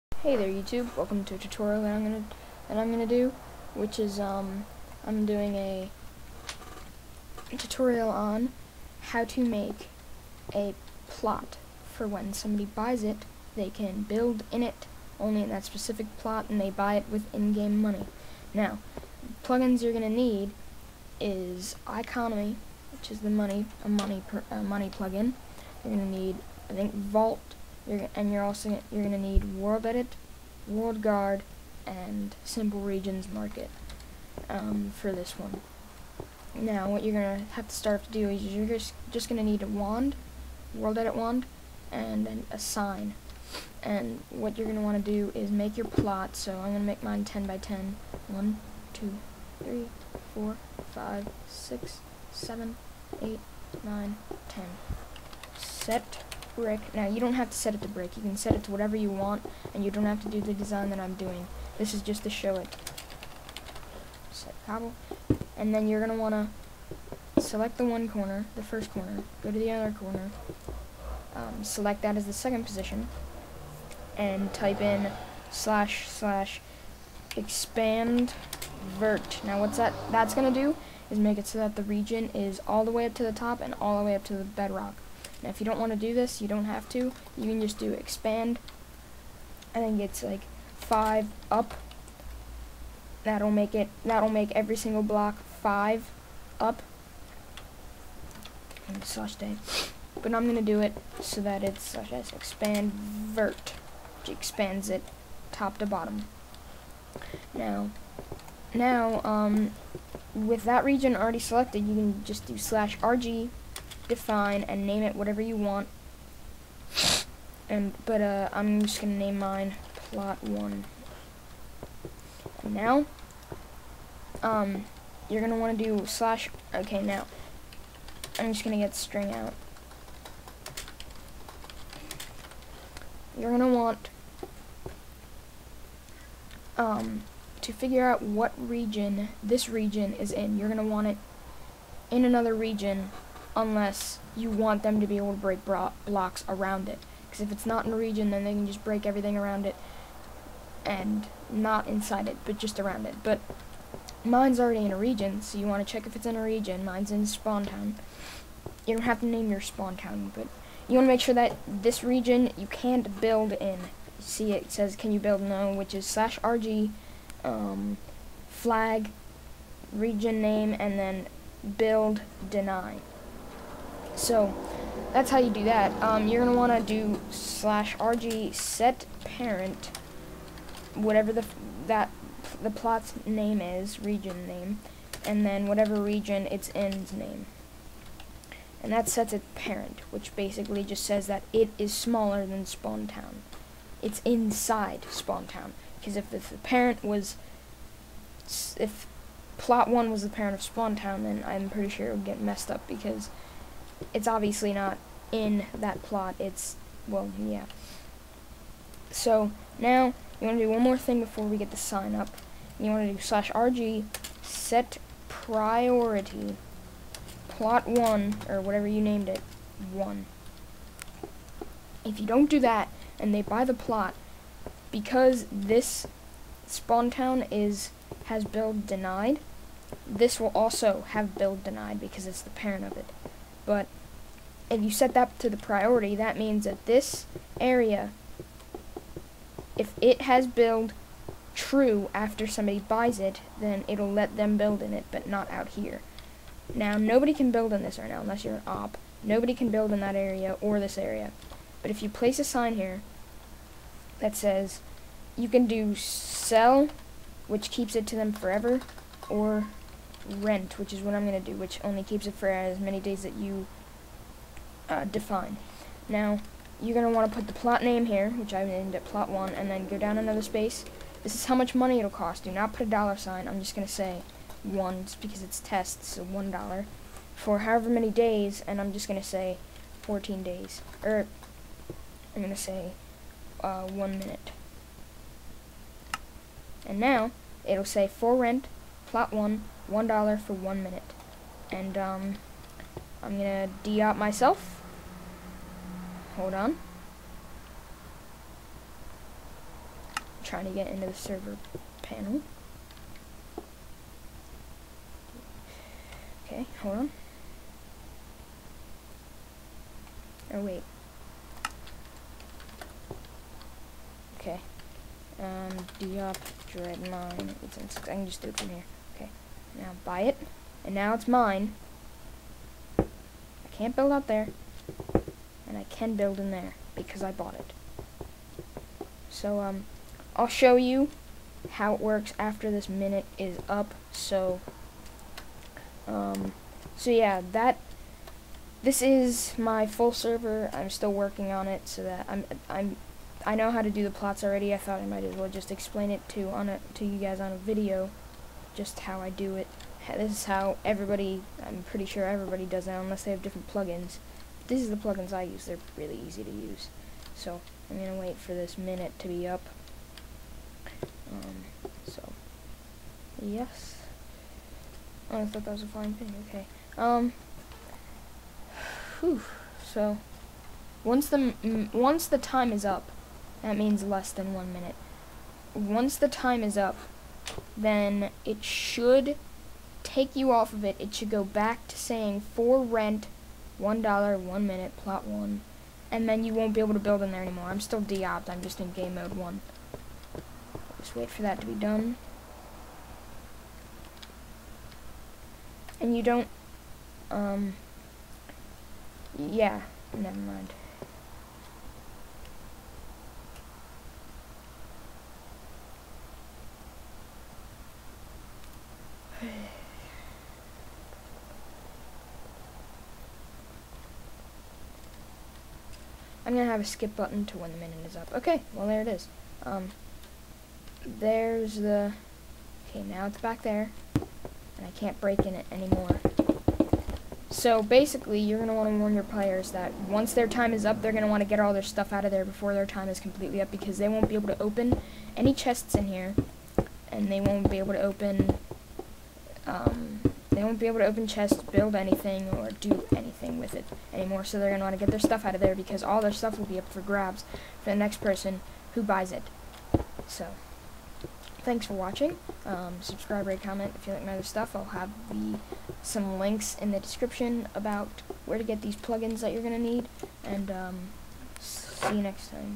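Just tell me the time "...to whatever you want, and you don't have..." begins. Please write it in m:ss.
0:58.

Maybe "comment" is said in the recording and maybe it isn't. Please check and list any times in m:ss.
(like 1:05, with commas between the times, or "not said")
7:33.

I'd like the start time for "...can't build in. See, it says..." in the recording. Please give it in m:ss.
2:42.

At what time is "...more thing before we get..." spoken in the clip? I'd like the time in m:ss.
3:30.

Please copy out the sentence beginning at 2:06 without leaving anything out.
Okay, now I'm just gonna get string out.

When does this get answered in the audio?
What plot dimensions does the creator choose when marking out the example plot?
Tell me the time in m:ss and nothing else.
0:47.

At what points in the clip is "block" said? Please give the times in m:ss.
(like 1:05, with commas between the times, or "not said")
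1:35, 2:25.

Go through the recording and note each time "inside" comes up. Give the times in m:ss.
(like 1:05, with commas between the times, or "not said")
2:31, 3:14.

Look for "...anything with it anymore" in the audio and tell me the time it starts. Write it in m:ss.
7:23.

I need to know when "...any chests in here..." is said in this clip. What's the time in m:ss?
7:15.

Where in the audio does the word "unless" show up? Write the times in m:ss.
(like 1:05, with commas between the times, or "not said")
2:23, 4:08, 5:52.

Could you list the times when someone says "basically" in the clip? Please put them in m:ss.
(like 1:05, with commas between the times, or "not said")
3:10, 7:07.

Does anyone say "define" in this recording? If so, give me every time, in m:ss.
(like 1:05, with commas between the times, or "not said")
1:54, 4:25.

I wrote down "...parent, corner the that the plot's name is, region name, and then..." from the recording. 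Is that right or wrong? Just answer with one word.
wrong.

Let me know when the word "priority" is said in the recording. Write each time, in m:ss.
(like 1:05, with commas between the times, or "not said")
3:35, 3:55.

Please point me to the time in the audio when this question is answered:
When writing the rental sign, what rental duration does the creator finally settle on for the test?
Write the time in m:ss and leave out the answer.
4:43.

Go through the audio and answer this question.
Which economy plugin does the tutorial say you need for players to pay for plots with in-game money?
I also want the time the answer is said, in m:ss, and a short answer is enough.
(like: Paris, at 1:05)
iConomy, at 0:21.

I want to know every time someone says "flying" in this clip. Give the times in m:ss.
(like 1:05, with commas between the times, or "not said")
6:05.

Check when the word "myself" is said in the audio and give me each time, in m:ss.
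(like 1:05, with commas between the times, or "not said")
4:54.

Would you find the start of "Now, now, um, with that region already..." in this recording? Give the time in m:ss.
1:47.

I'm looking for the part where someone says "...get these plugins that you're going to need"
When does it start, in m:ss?
7:38.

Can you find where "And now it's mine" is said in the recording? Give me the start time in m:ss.
5:20.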